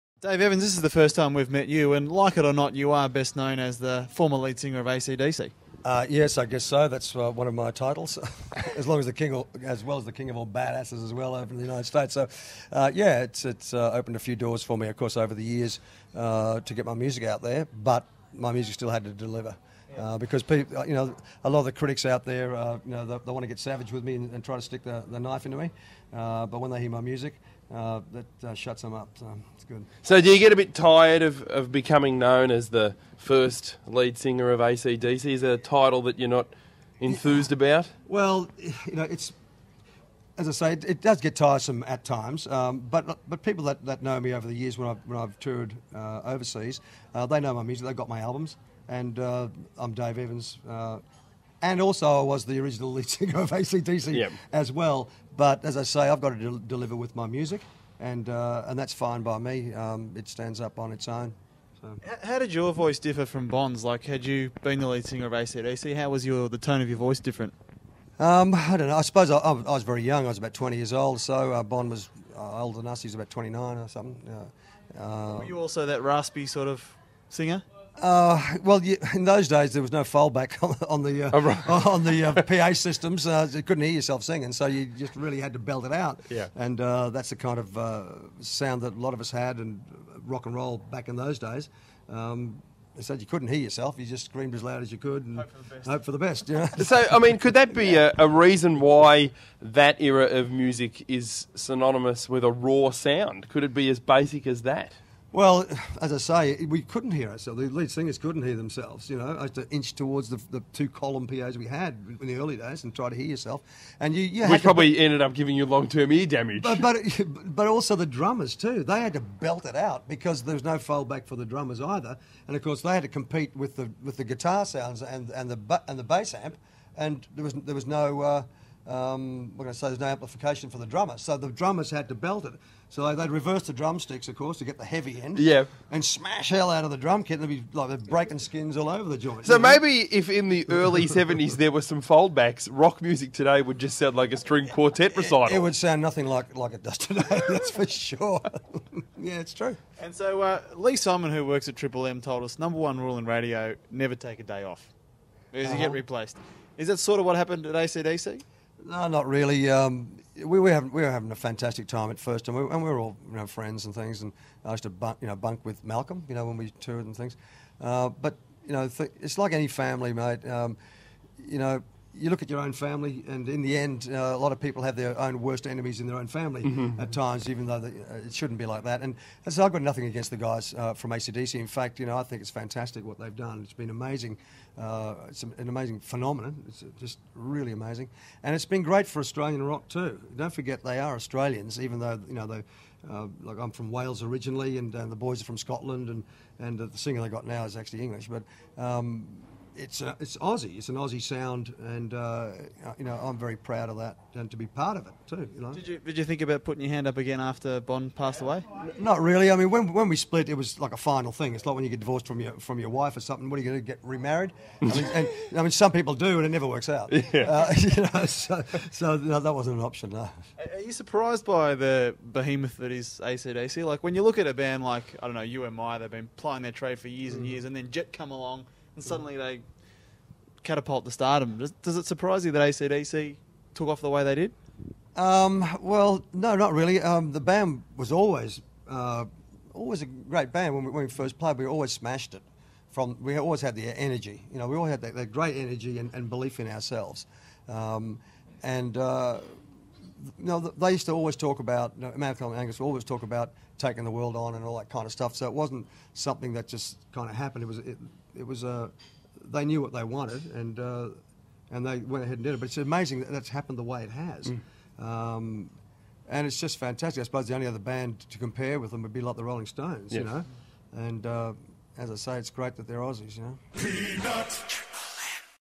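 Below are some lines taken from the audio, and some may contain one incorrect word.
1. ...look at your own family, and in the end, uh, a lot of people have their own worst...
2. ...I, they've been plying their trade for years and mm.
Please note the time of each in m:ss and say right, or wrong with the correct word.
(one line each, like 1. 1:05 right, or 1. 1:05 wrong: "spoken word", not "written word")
1. 2:52 right
2. 3:45 right.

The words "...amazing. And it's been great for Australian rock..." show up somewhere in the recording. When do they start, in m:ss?
3:07.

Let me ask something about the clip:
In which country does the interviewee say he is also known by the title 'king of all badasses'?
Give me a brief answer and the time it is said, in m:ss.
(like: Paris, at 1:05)
United States, at 0:11.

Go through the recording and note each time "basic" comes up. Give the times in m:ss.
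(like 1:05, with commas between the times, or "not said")
1:44.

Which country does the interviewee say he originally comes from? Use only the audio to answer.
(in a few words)
Wales.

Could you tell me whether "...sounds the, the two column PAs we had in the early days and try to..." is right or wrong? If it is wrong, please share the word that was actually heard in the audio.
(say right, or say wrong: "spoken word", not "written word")
wrong: "towards", not "sounds".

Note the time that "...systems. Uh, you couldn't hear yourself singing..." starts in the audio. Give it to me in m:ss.
1:22.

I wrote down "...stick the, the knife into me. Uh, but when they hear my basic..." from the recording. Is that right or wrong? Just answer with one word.
wrong.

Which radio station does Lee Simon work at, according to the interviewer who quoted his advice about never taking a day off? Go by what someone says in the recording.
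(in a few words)
Triple M.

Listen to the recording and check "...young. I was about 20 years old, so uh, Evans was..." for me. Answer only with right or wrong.
wrong.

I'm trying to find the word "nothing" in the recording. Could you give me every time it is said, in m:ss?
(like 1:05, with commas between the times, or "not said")
2:26, 2:59.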